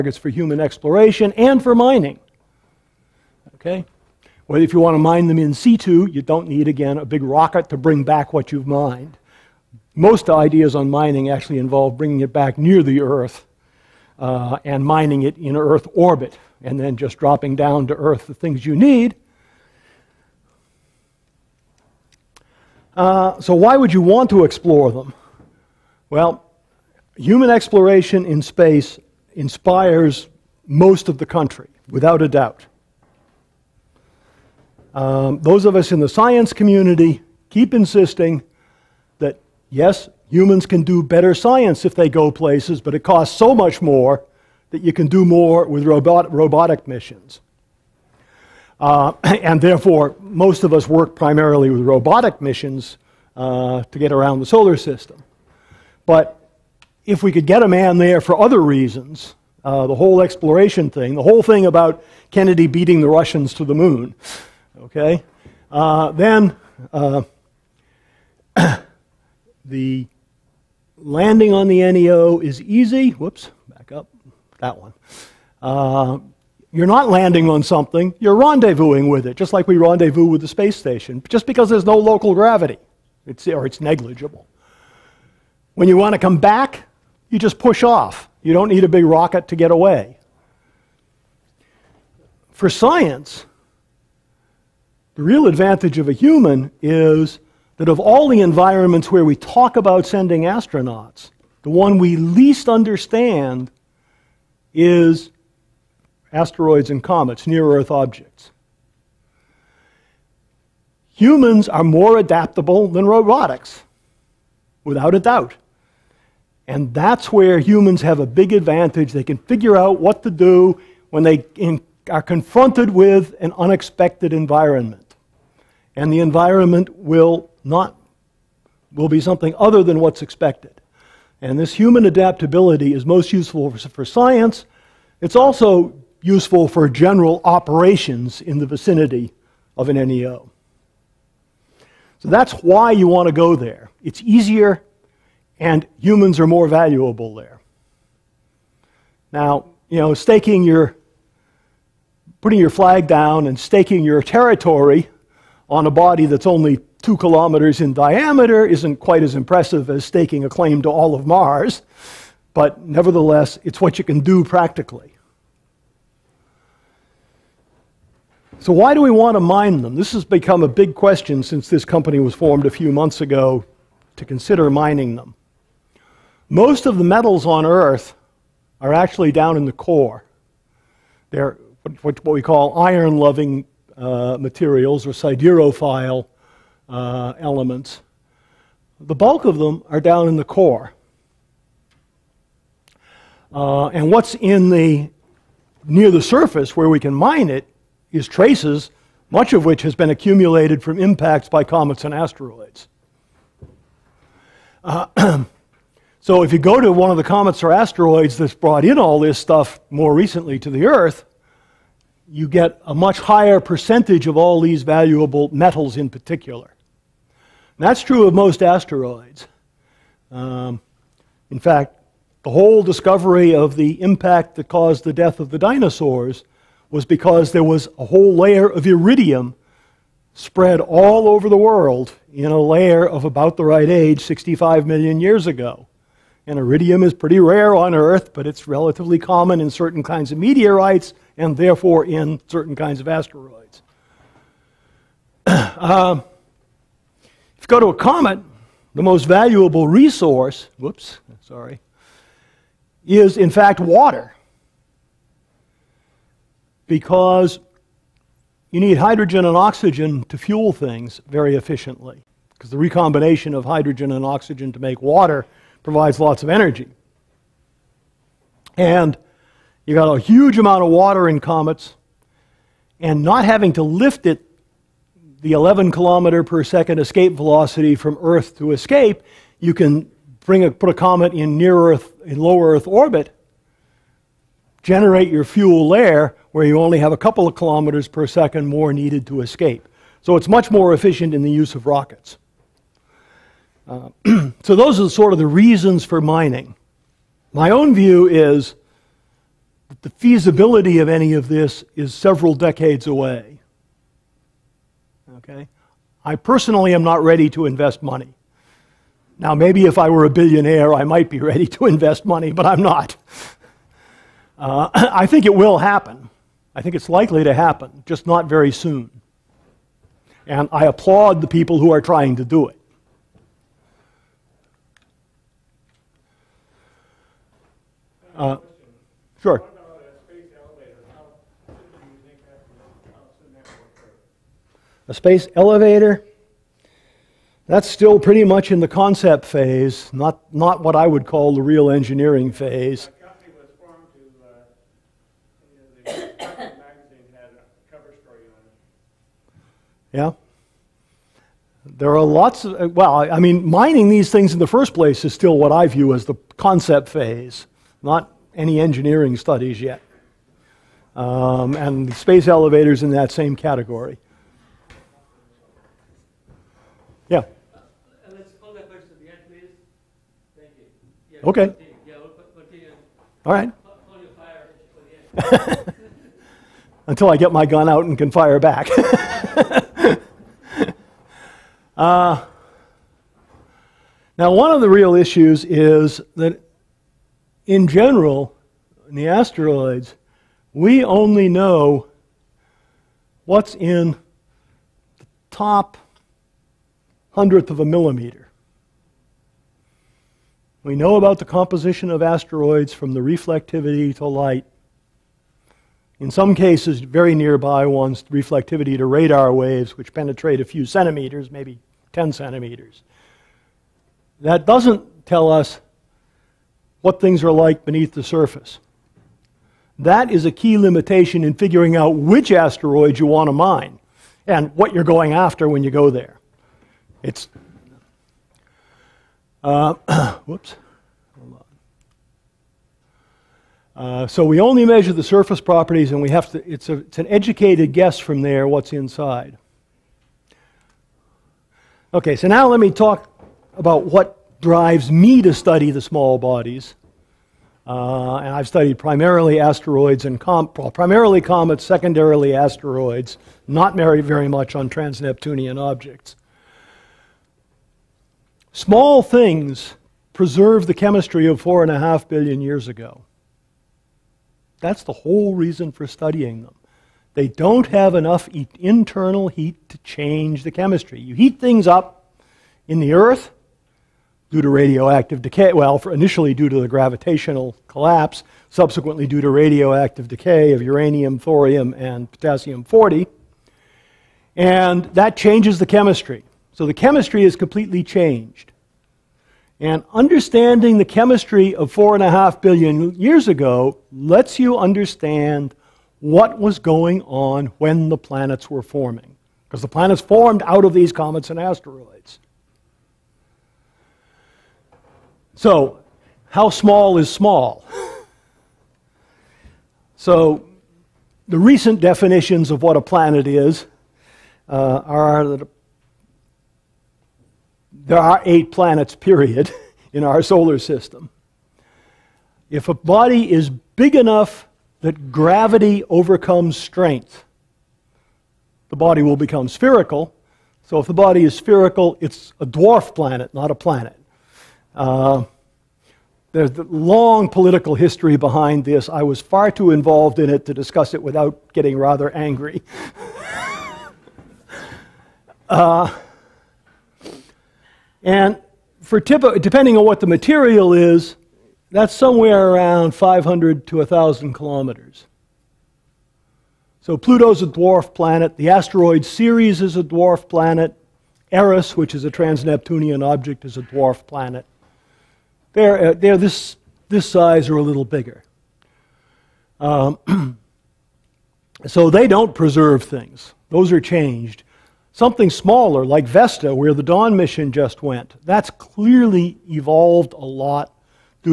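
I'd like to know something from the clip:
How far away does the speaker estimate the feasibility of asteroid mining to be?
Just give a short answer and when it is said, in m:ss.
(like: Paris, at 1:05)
several decades, at 5:02.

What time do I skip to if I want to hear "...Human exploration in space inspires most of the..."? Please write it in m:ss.
0:27.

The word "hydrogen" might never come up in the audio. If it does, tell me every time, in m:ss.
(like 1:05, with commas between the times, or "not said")
4:18, 4:23.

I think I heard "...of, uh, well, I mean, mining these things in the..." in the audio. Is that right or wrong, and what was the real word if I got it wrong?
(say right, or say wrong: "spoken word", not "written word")
right.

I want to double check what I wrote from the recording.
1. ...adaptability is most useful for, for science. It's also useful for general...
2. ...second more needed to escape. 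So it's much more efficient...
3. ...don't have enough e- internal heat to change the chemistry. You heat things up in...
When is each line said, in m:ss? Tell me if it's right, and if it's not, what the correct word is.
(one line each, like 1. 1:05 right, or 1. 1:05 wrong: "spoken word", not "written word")
1. 2:12 right
2. 4:48 right
3. 7:47 right.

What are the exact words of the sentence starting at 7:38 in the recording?
Small things preserve the chemistry of four and a half billion years ago.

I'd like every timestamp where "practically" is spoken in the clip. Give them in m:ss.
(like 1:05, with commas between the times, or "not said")
2:44.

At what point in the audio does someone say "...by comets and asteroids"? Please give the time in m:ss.
3:21.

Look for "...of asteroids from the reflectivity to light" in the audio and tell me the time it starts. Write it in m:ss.
6:42.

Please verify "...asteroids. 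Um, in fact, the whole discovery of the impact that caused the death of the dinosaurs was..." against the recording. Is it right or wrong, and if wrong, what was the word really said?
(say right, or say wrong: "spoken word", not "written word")
right.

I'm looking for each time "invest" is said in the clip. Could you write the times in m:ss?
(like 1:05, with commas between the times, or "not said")
5:07, 5:11.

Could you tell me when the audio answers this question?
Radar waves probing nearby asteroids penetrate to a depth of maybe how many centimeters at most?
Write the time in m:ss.
6:52.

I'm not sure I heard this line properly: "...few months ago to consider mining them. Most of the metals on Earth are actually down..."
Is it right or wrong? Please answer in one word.
right.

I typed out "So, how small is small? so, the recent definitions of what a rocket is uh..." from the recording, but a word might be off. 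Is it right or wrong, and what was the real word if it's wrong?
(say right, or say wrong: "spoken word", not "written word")
wrong: "planet", not "rocket".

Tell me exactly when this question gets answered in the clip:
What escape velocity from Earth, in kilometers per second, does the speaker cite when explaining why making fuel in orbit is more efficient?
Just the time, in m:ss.
4:35.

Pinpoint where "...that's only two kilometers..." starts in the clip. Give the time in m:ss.
2:36.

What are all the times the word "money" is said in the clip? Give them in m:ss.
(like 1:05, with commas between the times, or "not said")
5:08, 5:12.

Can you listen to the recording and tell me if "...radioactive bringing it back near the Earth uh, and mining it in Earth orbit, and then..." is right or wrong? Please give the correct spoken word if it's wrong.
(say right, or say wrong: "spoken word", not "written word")
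wrong: "involve", not "radioactive".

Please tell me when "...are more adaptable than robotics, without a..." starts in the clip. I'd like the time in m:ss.
1:51.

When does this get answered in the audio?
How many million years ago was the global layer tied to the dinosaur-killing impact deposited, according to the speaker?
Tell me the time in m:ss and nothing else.
3:54.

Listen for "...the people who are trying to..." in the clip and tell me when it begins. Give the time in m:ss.
5:21.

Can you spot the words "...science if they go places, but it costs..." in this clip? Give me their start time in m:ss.
0:41.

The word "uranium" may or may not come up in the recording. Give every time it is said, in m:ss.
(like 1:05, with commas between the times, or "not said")
8:00.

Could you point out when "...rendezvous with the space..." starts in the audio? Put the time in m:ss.
1:19.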